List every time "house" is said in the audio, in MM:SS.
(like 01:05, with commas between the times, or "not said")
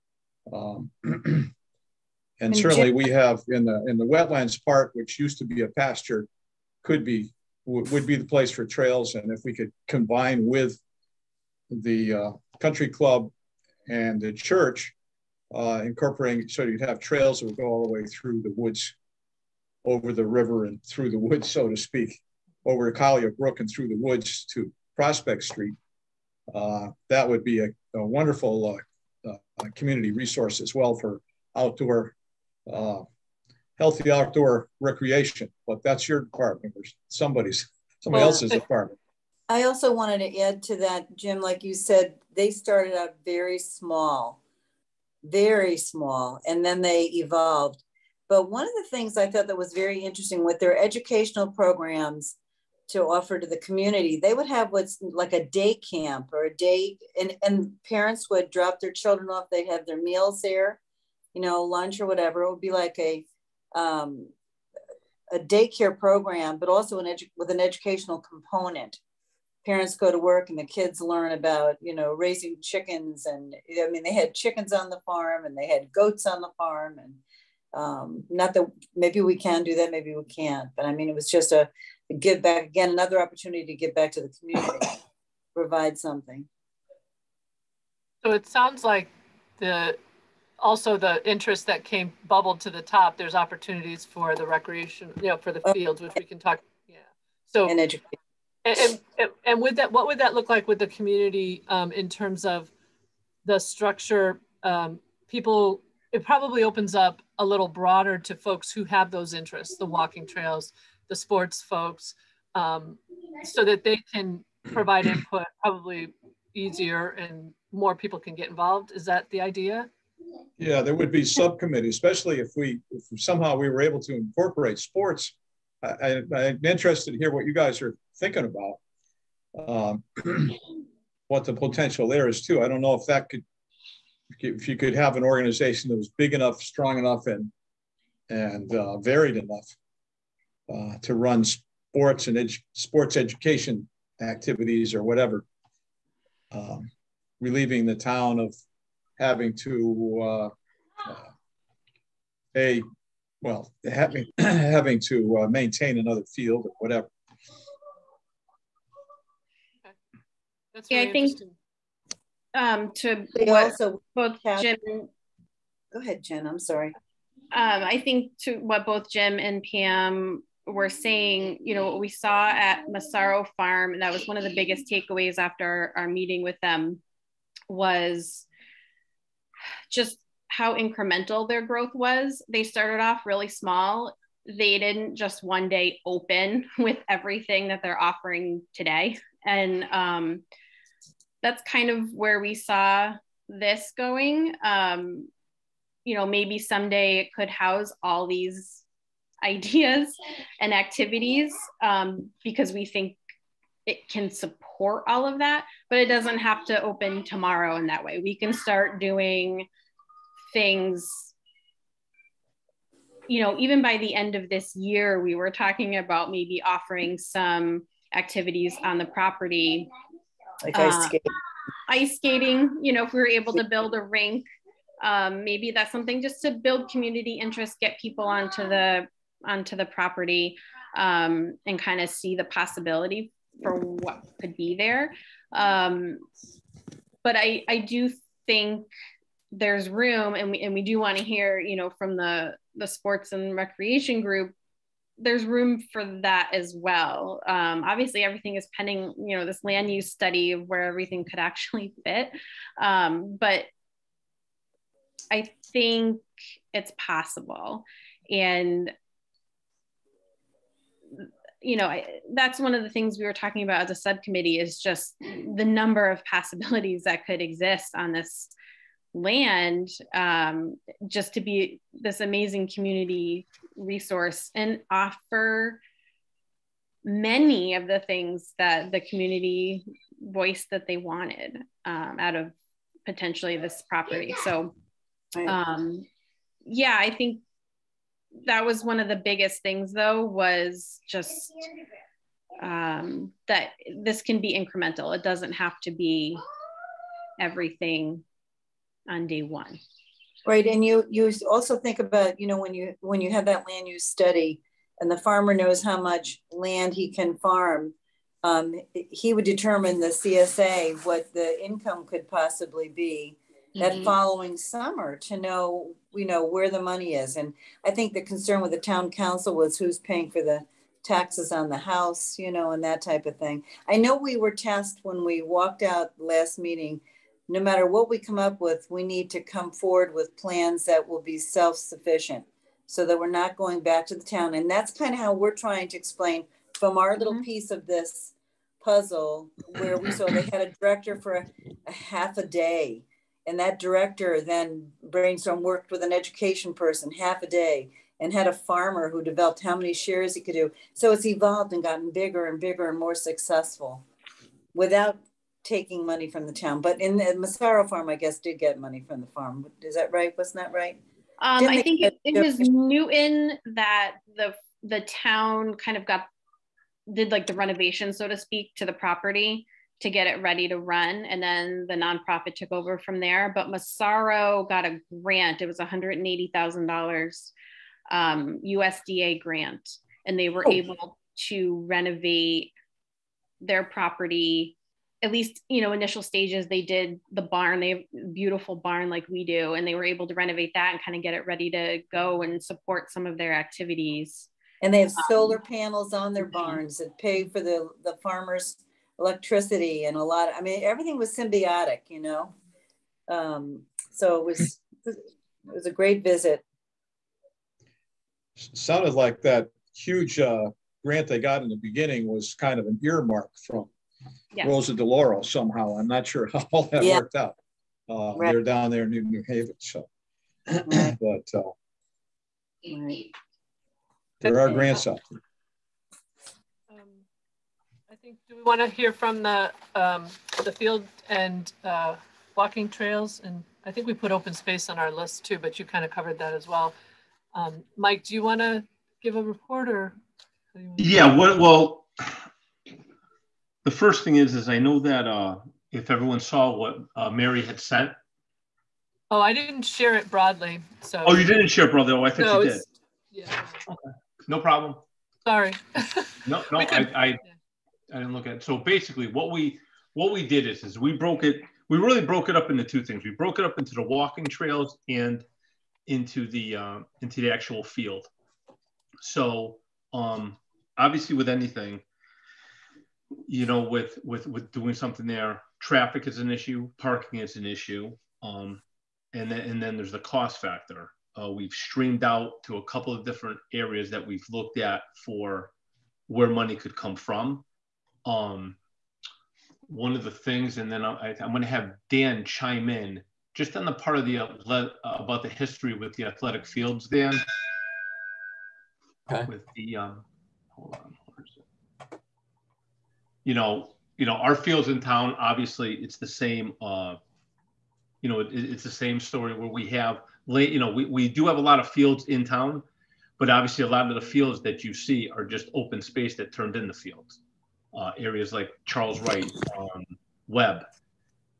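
03:17, 05:21.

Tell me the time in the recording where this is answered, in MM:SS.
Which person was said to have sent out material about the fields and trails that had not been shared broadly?
07:27.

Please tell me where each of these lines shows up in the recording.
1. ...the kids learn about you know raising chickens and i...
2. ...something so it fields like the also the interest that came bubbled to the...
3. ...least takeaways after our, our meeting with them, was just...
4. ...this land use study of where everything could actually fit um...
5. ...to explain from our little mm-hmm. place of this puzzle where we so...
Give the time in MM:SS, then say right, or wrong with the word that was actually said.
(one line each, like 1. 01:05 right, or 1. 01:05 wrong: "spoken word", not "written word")
1. 01:10 right
2. 01:25 wrong: "sounds", not "fields"
3. 02:54 wrong: "biggest", not "least"
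4. 04:09 right
5. 05:35 wrong: "piece", not "place".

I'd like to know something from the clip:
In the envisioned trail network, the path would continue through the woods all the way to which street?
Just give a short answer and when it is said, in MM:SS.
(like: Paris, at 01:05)
Prospect Street, at 00:24.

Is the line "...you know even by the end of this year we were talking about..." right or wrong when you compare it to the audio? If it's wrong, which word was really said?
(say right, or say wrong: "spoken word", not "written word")
right.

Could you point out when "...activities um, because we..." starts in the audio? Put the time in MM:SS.
03:20.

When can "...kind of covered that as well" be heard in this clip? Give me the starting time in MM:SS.
07:15.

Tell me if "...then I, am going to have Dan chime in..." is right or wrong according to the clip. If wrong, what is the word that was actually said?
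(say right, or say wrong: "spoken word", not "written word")
right.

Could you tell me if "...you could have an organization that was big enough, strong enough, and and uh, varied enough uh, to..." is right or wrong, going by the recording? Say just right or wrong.
right.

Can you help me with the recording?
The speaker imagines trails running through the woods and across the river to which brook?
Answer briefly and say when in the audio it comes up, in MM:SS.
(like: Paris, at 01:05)
Collier Brook, at 00:22.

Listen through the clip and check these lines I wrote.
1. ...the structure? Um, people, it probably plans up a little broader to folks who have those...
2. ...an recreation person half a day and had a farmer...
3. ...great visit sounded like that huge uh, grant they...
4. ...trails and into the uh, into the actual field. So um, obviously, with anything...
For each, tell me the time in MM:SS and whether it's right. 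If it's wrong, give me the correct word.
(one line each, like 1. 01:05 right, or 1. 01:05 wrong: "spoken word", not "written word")
1. 01:43 wrong: "opens", not "plans"
2. 05:46 wrong: "education", not "recreation"
3. 06:45 right
4. 07:44 right.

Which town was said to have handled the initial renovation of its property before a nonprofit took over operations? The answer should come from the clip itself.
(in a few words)
Newton.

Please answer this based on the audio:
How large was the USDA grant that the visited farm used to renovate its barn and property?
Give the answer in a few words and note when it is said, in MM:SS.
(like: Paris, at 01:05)
$180,000, at 06:15.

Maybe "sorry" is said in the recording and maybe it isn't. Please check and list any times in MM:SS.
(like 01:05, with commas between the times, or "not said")
02:46, 07:35.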